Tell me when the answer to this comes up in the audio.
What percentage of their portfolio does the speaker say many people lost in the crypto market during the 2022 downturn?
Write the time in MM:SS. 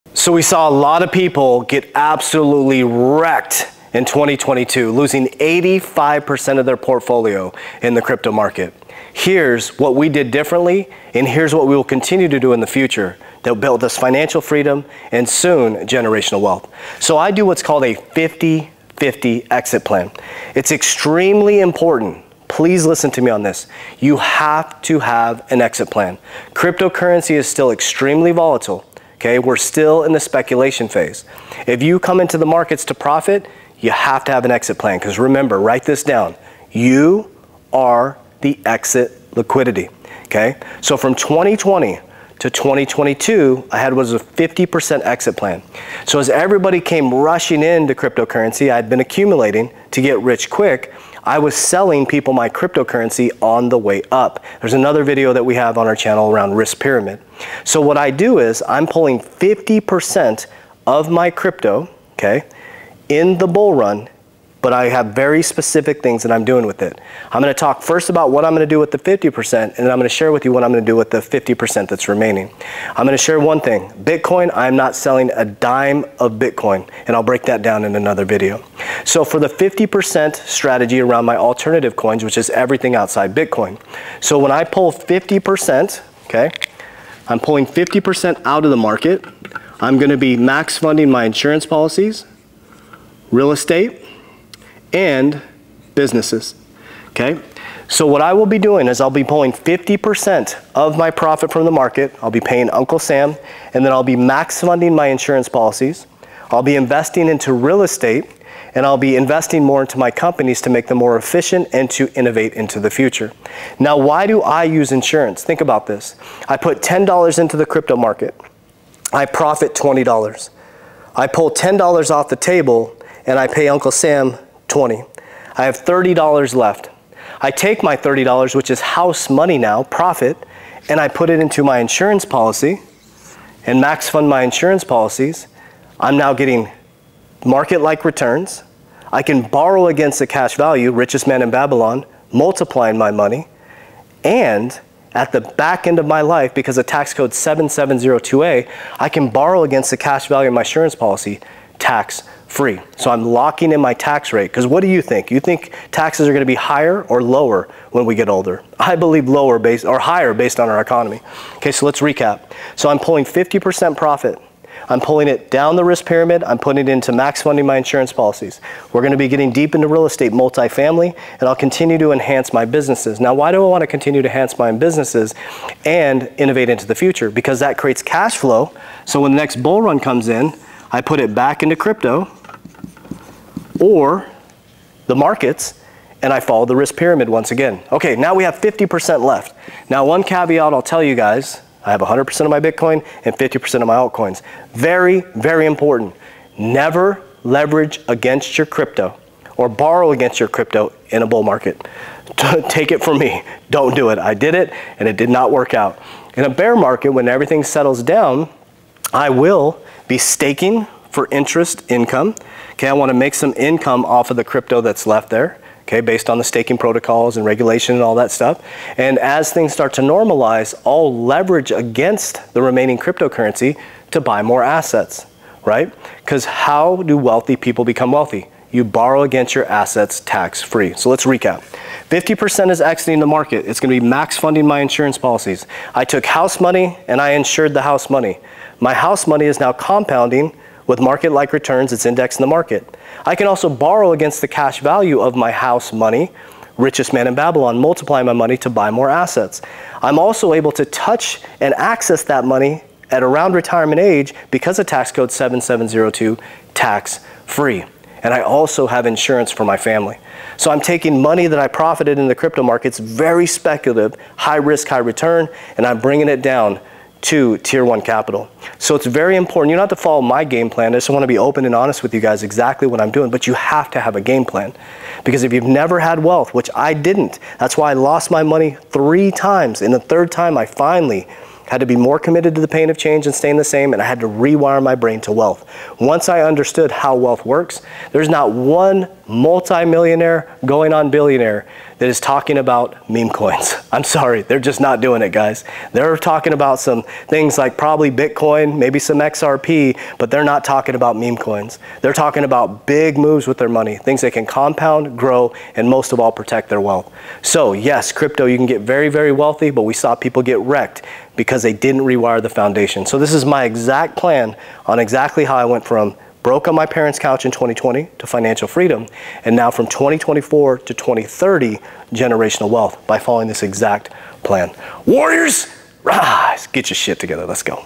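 00:05.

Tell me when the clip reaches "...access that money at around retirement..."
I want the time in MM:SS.
04:11.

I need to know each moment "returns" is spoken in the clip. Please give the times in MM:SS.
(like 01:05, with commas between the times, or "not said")
02:18, 04:01, 04:24.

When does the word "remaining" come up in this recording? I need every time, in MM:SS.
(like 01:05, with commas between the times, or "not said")
01:12, 03:42.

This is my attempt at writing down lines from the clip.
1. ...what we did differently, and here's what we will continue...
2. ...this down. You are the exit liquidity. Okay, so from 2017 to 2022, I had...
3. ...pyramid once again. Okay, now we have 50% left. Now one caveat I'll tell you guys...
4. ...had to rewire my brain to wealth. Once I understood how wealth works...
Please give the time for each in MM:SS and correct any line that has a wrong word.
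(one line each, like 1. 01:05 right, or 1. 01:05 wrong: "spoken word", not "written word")
1. 00:09 right
2. 00:35 wrong: "2020", not "2017"
3. 03:06 right
4. 04:44 right.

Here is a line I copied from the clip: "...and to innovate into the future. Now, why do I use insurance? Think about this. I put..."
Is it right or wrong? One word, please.
right.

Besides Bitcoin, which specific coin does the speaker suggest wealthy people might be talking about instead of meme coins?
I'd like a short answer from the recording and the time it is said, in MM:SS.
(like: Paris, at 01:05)
XRP, at 04:59.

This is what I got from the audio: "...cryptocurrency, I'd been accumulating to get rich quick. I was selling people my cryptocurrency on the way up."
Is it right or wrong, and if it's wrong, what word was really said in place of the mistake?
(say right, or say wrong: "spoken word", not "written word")
right.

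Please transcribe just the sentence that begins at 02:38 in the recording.
I believe lower based or higher based on our economy.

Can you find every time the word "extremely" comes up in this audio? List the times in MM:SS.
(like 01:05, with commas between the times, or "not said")
00:20, 00:27.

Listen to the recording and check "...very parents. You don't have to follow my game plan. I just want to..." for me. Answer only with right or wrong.
wrong.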